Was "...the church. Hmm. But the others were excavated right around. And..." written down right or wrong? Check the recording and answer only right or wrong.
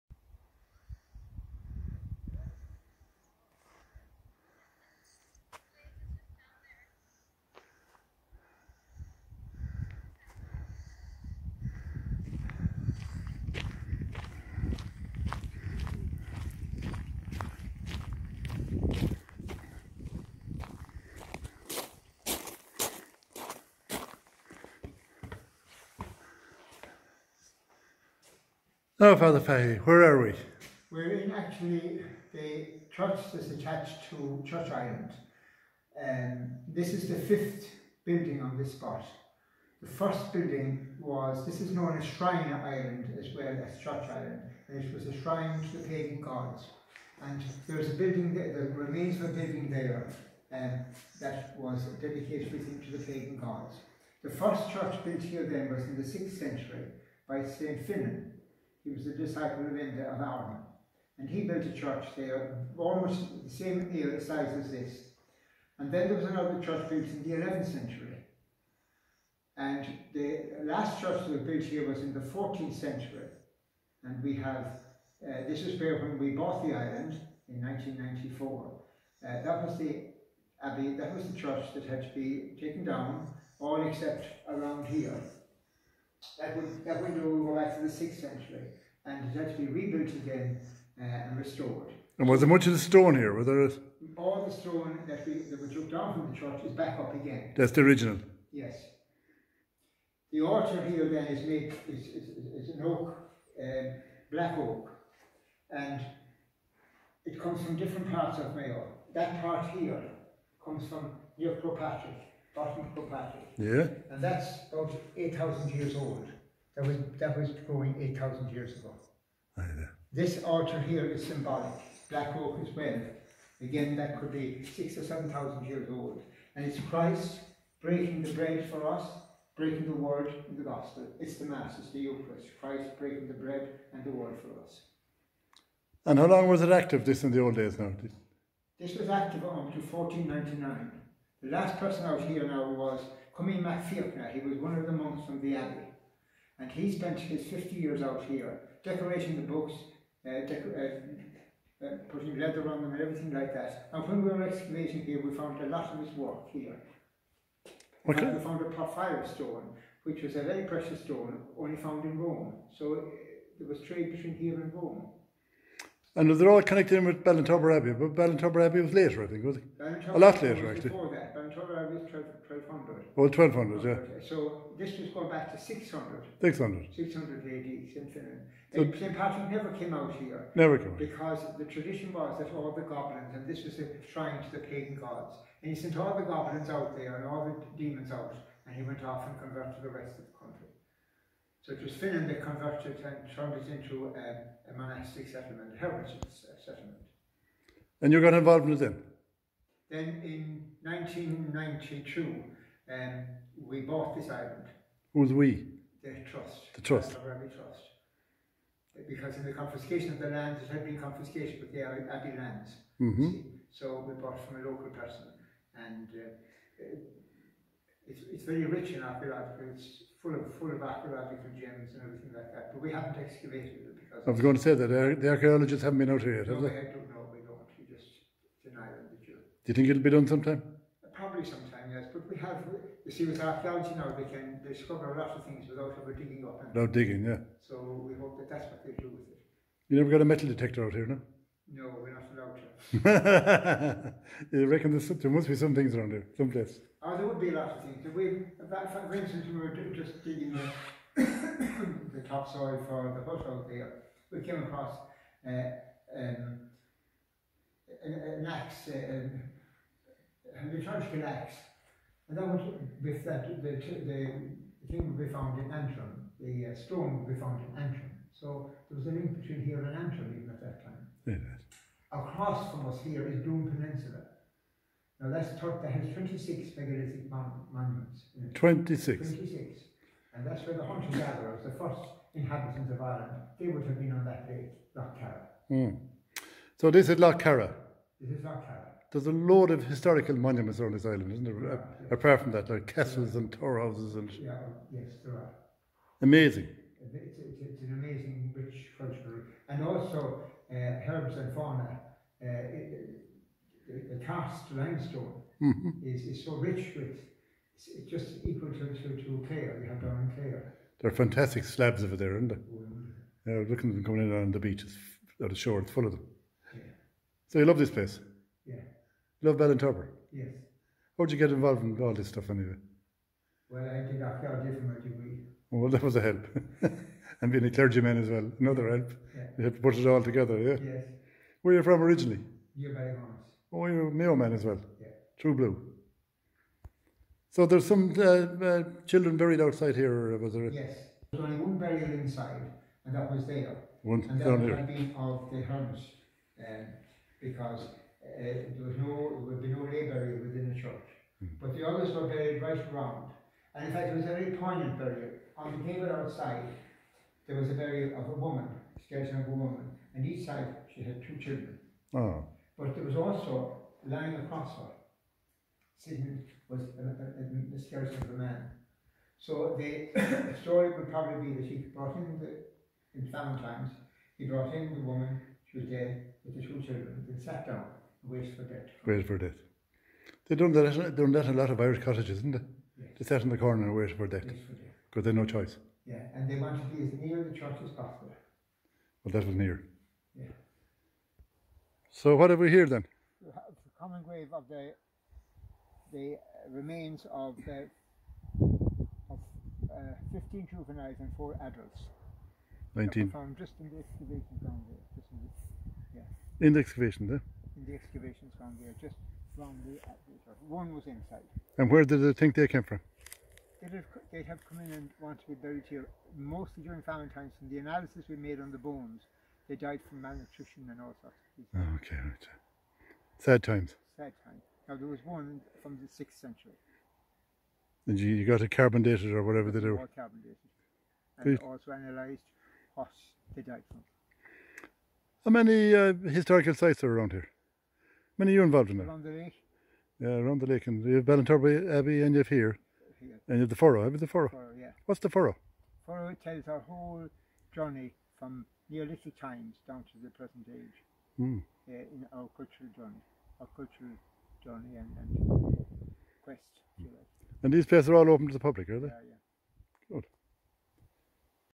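wrong.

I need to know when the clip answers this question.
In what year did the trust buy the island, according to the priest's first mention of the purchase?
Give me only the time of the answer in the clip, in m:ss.
1:17.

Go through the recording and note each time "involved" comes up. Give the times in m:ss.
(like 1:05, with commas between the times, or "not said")
3:18, 5:21, 7:18.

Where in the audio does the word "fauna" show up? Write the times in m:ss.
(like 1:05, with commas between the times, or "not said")
5:01.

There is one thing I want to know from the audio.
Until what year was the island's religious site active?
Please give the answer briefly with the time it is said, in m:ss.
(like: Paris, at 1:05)
1499, at 2:19.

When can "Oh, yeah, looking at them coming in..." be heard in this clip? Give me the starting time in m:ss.
5:12.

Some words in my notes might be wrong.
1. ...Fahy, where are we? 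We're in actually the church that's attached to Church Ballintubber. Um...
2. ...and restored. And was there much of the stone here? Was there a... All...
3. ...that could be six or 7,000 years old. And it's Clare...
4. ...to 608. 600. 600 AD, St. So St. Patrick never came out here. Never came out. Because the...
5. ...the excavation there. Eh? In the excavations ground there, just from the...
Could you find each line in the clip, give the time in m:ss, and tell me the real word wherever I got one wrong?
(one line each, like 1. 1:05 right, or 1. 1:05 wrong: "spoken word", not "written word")
1. 0:29 wrong: "Island", not "Ballintubber"
2. 1:31 right
3. 2:03 wrong: "Christ", not "Clare"
4. 2:55 wrong: "600", not "608"
5. 6:46 right.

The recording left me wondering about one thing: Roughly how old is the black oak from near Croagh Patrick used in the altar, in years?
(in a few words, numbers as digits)
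8,000.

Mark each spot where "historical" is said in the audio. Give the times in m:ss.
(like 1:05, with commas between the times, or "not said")
4:49, 7:16.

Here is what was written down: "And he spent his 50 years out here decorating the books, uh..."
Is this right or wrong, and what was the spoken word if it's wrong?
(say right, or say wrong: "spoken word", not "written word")
right.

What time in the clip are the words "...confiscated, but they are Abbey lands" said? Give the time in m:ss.
3:30.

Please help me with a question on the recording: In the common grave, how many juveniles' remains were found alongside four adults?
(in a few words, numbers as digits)
15.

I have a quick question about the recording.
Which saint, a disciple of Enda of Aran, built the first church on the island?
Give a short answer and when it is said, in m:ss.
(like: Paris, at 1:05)
St. Finan, at 0:57.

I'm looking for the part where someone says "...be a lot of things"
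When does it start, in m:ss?
4:07.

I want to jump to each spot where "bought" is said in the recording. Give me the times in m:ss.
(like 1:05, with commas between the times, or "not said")
1:16, 3:23, 3:34.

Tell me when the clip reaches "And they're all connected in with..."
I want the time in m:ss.
2:46.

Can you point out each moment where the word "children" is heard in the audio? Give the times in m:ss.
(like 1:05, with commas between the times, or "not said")
5:39, 6:01, 6:16.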